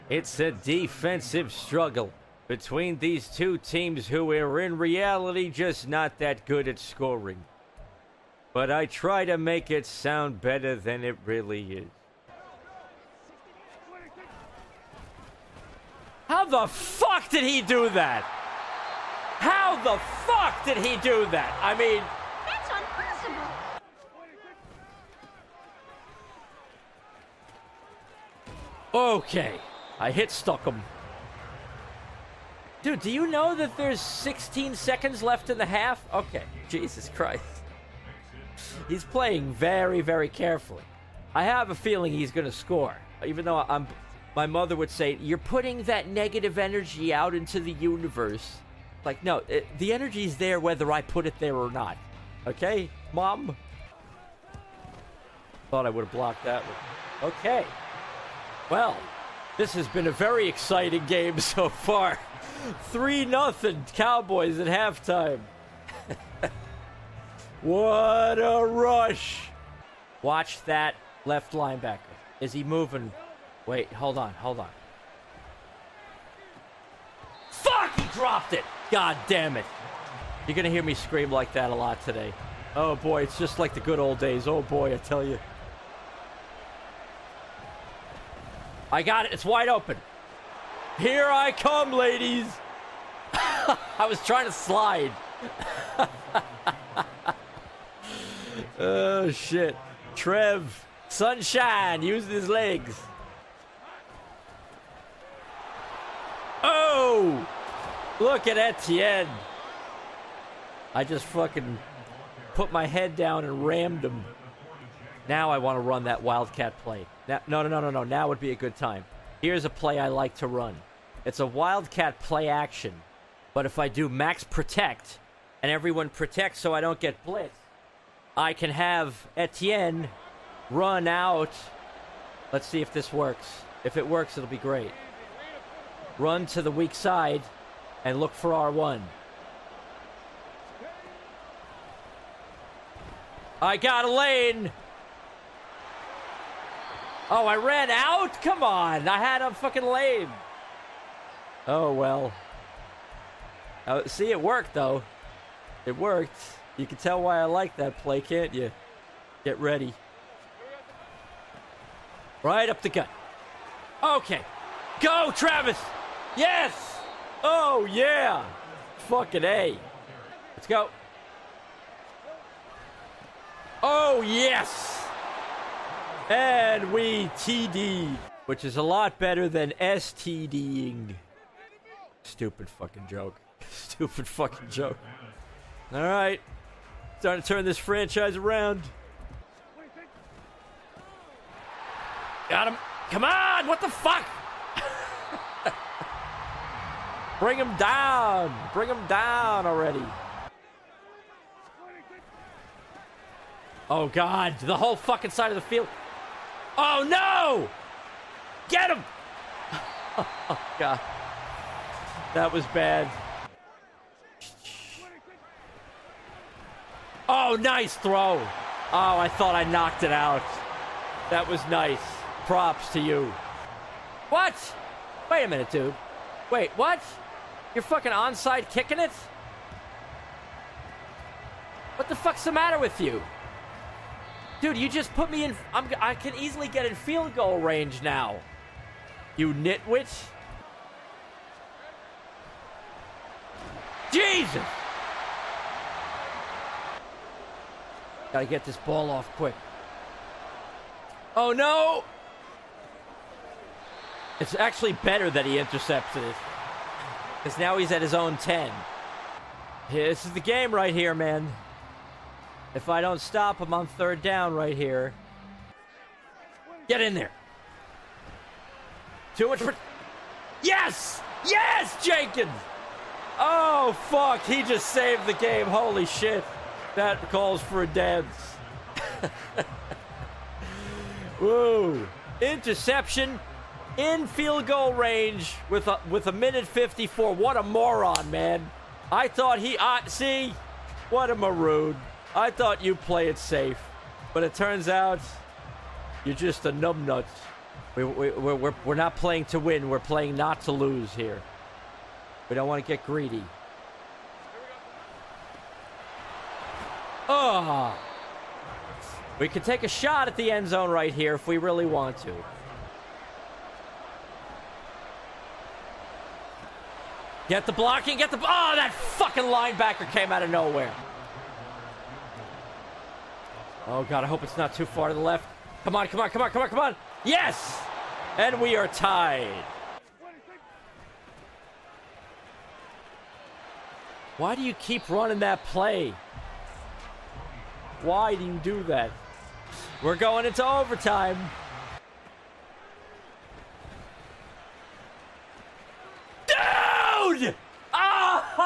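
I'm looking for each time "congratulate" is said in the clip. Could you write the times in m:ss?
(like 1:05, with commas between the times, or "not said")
not said.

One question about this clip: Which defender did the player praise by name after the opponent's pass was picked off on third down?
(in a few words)
Jenkins.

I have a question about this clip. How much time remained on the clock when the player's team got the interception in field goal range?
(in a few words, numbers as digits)
1:54.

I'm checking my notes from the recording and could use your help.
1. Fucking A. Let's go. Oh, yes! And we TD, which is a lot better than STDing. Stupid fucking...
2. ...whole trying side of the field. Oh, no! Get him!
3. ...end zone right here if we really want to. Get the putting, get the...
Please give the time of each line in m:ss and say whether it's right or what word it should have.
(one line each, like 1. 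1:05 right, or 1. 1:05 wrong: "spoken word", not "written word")
1. 2:49 right
2. 3:24 wrong: "fucking", not "trying"
3. 5:10 wrong: "blocking", not "putting".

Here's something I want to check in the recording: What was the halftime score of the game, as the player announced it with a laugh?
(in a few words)
3-0 Cowboys.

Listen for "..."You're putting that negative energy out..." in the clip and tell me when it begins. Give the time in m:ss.
0:45.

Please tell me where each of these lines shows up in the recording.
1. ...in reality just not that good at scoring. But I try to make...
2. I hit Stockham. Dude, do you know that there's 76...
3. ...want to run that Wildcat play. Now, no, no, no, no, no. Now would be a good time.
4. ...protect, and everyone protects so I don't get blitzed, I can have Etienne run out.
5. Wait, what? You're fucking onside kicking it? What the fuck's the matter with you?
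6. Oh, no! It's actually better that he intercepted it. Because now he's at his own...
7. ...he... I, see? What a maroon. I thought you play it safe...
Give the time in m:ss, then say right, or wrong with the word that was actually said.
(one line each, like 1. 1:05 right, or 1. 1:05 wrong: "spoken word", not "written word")
1. 0:04 right
2. 0:29 wrong: "16", not "76"
3. 1:55 right
4. 2:04 right
5. 3:46 right
6. 4:11 right
7. 4:49 right.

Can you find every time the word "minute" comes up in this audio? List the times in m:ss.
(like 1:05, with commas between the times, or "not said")
3:45, 4:46.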